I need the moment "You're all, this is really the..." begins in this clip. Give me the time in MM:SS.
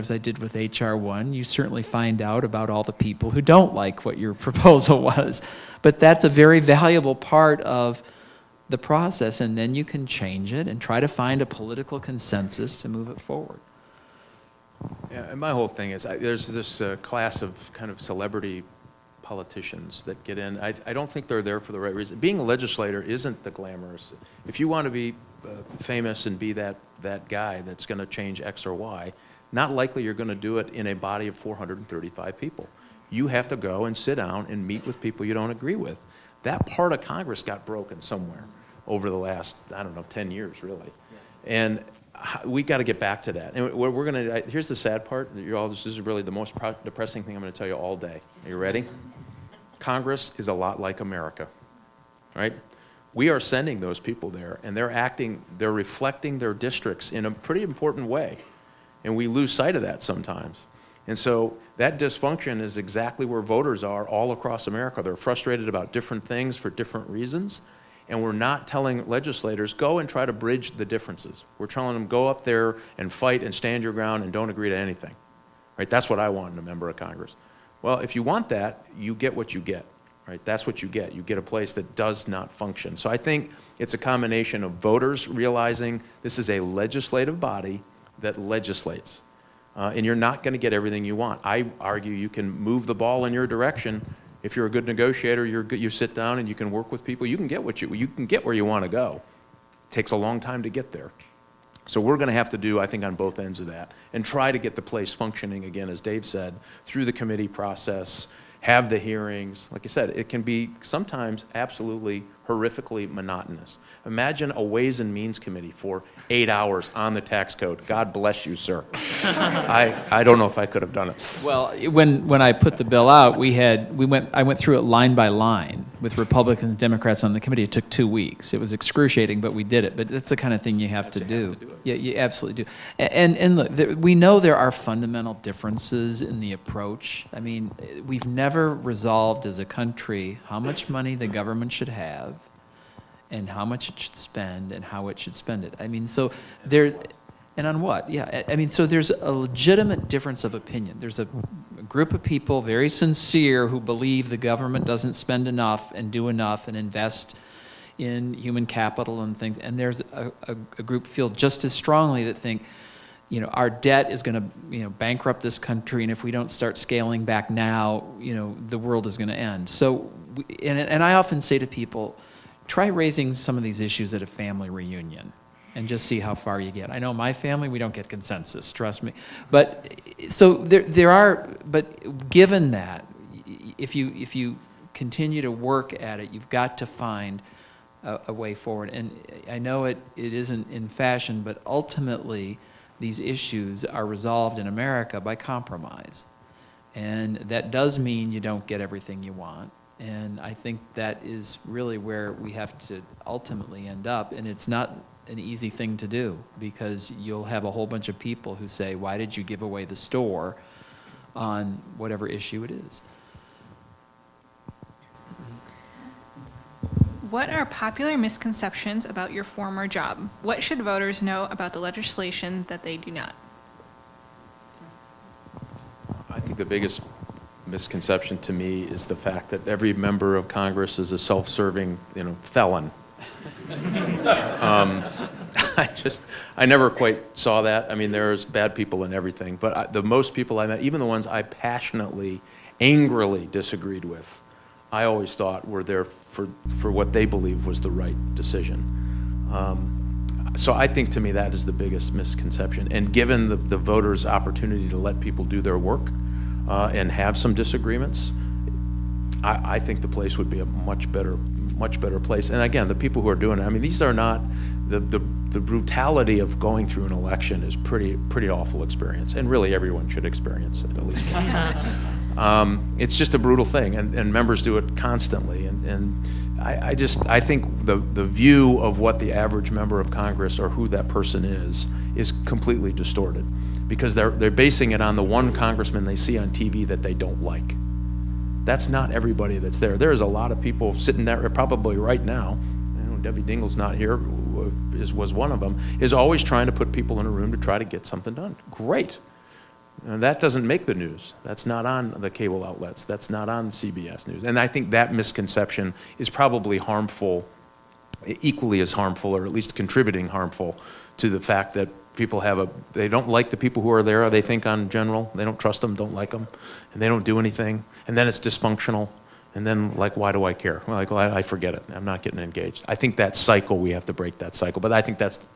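00:45.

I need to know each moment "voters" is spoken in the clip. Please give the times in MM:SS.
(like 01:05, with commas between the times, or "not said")
01:03, 01:24, 03:40, 04:13.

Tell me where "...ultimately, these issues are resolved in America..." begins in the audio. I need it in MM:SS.
03:11.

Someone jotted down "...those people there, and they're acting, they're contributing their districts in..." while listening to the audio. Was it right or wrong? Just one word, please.
wrong.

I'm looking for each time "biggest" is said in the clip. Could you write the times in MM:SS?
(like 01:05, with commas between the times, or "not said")
03:46, 04:11.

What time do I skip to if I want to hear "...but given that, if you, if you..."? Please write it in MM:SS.
03:01.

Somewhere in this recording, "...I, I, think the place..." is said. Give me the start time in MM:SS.
04:19.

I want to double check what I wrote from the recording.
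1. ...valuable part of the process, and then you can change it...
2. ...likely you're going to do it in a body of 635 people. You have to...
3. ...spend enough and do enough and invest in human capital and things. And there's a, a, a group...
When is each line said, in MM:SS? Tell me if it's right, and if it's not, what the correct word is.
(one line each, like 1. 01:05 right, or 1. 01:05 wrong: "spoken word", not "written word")
1. 00:06 right
2. 00:29 wrong: "435", not "635"
3. 02:35 right.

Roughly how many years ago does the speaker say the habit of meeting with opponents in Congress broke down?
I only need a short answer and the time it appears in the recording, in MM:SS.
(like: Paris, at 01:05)
10 years, at 00:40.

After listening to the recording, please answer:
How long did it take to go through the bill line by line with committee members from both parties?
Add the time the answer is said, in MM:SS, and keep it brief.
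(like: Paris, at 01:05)
Two weeks, at 02:07.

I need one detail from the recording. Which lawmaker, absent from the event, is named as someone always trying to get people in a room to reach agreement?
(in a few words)
Debbie Dingell.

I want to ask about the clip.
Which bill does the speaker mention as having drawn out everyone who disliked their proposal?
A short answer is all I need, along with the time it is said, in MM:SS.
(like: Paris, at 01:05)
HR1, at 00:00.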